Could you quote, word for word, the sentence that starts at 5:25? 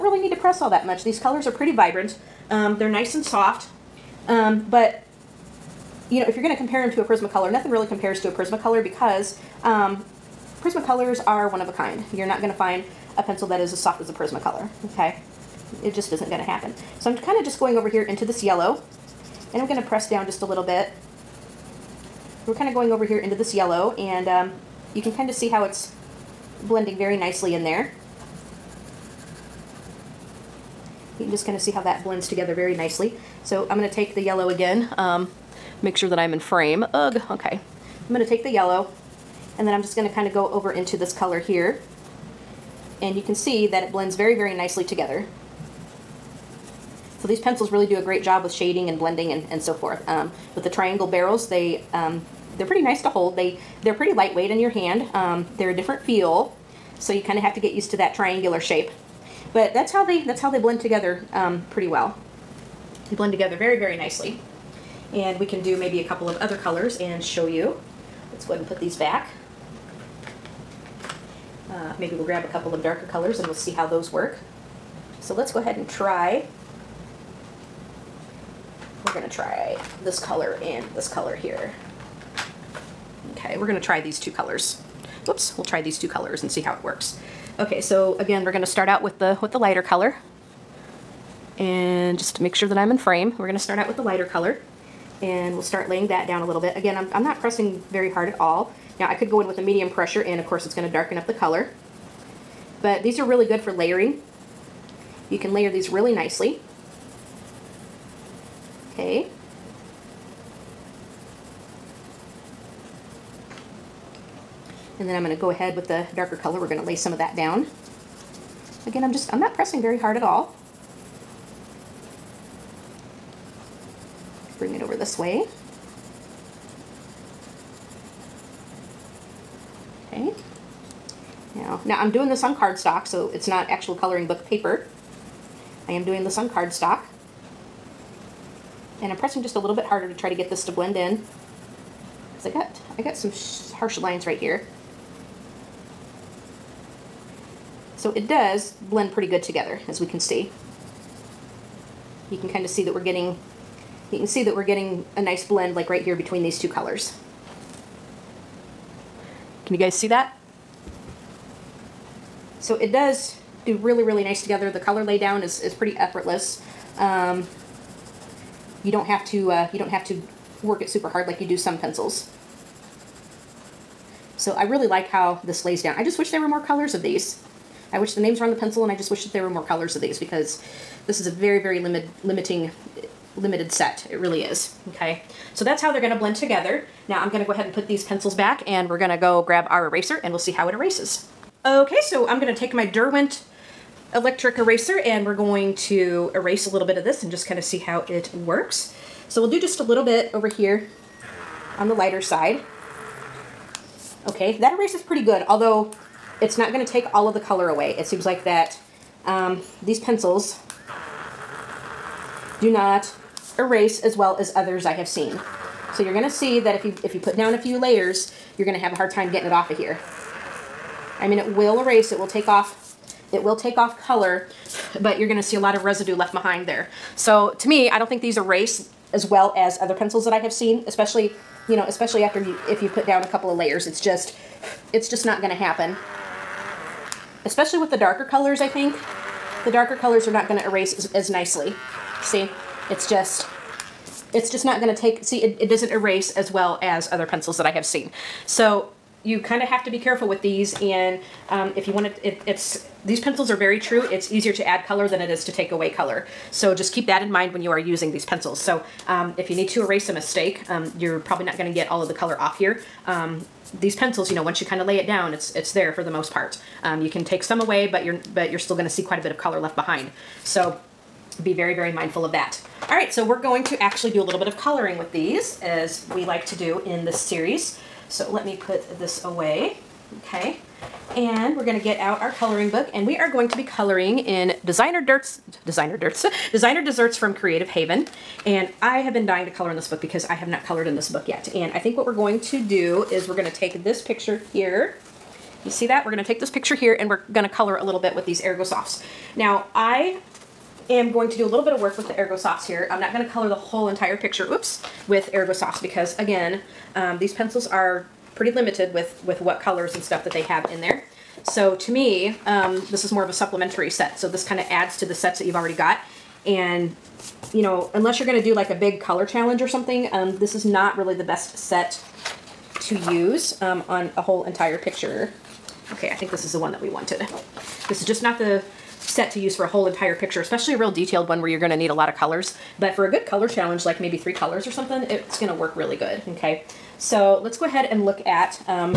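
Okay, I think this is the one that we wanted.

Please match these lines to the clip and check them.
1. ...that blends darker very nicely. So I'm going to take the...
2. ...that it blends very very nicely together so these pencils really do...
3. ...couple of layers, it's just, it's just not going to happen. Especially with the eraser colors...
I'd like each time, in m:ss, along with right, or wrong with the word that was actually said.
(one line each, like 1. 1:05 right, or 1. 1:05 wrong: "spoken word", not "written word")
1. 0:31 wrong: "together", not "darker"
2. 0:43 right
3. 3:53 wrong: "darker", not "eraser".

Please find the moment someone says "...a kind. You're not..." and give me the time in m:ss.
0:11.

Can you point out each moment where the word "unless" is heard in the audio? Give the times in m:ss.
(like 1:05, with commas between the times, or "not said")
5:17.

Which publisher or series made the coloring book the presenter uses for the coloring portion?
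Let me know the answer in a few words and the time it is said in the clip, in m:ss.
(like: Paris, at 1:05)
Creative Haven, at 4:47.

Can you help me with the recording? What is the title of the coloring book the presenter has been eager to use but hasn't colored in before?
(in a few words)
Designer Desserts.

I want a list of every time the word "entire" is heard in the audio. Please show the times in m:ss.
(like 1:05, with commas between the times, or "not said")
5:03, 5:24, 5:29.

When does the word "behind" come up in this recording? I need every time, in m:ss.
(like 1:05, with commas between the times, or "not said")
3:46, 4:29.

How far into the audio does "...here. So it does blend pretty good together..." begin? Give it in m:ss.
2:24.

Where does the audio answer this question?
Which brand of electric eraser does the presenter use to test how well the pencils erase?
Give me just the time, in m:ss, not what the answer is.
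3:12.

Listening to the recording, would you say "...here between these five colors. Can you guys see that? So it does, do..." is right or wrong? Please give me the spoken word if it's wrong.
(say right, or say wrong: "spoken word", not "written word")
wrong: "two", not "five".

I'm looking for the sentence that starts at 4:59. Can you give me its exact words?
Now, I am going to do a little bit of work with the Ergo Softs here.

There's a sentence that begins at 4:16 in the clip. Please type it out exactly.
So just keep that in mind when you are using these pencils.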